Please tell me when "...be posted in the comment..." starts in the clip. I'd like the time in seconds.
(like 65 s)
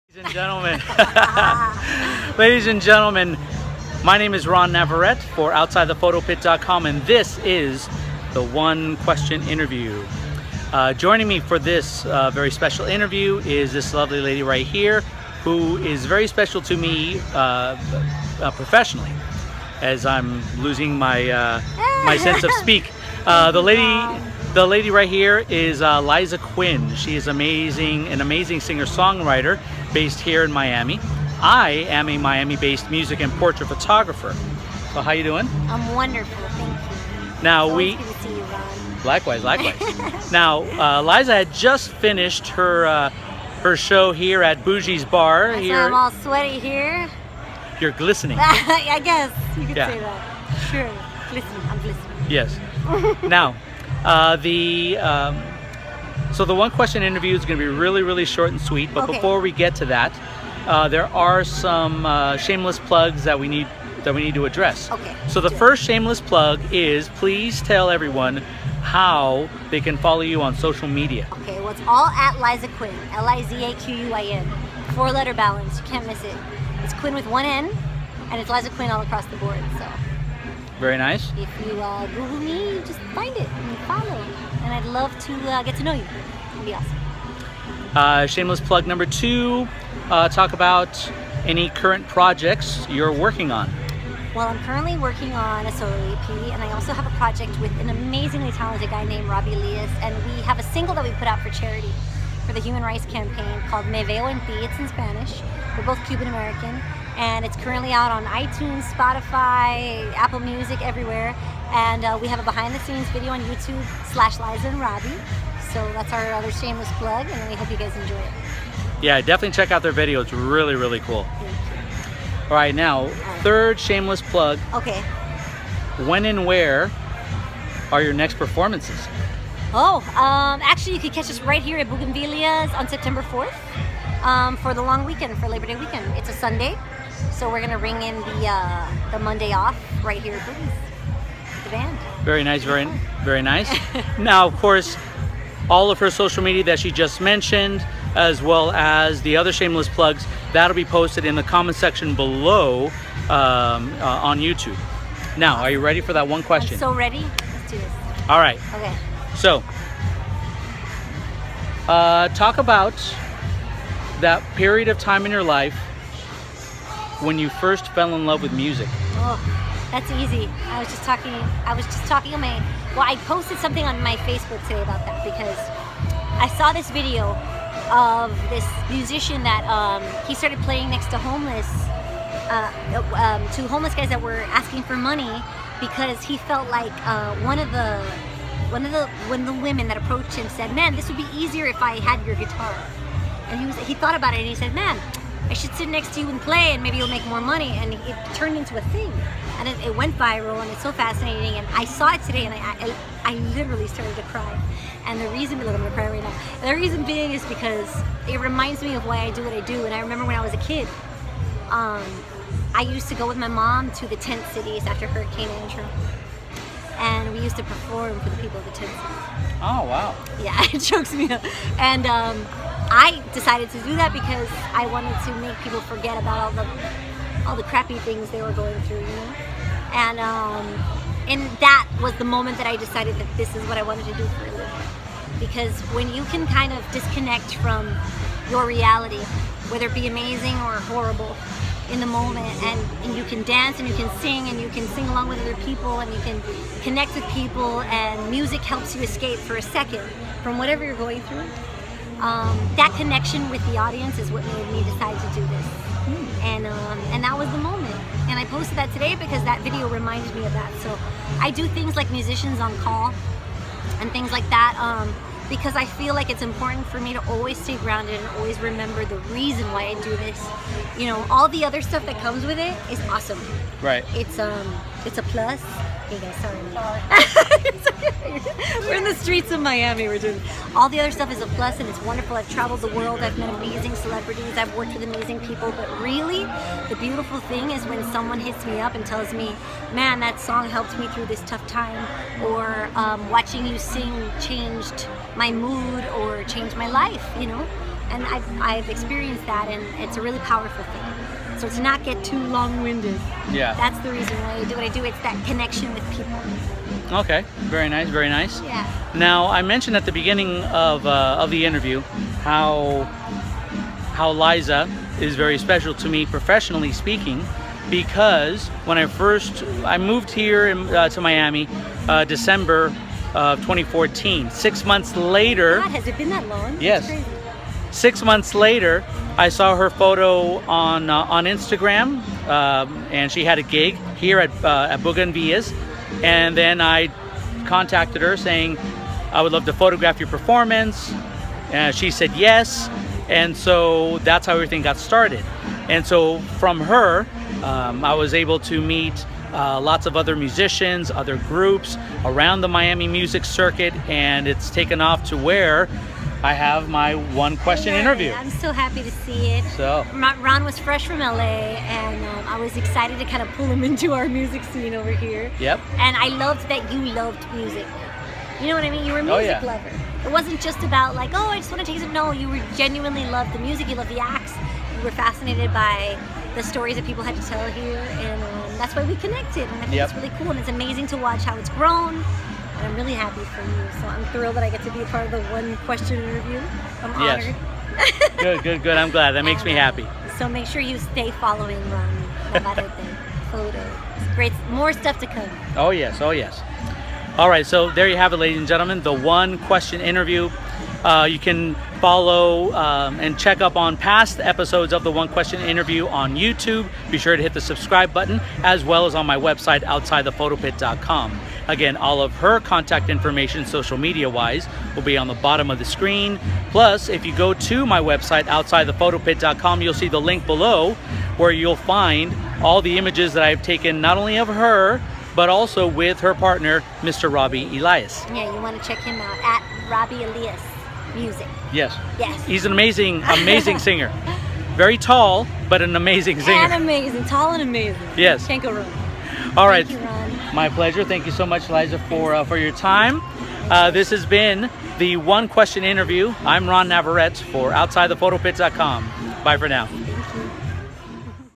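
150 s.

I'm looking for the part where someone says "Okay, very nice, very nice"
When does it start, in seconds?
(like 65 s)
307 s.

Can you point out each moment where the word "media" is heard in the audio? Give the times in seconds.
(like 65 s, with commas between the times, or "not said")
70 s, 146 s, 413 s.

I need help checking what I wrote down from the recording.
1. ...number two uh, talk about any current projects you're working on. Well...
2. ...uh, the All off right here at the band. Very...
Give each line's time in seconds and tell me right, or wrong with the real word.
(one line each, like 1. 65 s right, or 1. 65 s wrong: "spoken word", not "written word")
1. 88 s right
2. 138 s wrong: "Monday", not "All".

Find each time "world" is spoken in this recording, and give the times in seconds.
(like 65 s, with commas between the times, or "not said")
282 s.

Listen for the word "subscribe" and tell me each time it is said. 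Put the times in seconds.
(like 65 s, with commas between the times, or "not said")
407 s.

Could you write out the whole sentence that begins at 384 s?
So I'm thrilled that I get to be a part of the one question interview.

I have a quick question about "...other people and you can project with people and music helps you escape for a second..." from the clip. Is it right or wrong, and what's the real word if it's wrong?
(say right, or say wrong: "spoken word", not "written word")
wrong: "connect", not "project".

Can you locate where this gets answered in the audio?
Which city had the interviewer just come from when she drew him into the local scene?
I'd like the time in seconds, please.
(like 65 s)
361 s.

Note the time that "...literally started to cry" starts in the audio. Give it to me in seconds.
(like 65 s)
203 s.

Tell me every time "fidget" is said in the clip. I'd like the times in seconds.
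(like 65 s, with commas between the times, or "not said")
not said.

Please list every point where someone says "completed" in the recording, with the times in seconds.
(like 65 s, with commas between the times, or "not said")
not said.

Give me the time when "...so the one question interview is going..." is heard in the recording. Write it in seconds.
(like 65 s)
56 s.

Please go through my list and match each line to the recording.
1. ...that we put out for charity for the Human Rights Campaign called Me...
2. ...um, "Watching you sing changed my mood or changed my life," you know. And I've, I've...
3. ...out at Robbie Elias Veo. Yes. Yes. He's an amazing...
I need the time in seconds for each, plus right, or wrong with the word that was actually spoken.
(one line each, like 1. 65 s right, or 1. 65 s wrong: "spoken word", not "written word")
1. 100 s right
2. 292 s right
3. 429 s wrong: "Music", not "Veo".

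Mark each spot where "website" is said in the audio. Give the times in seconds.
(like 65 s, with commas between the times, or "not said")
409 s, 417 s.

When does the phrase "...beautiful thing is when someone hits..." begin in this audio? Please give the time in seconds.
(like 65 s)
286 s.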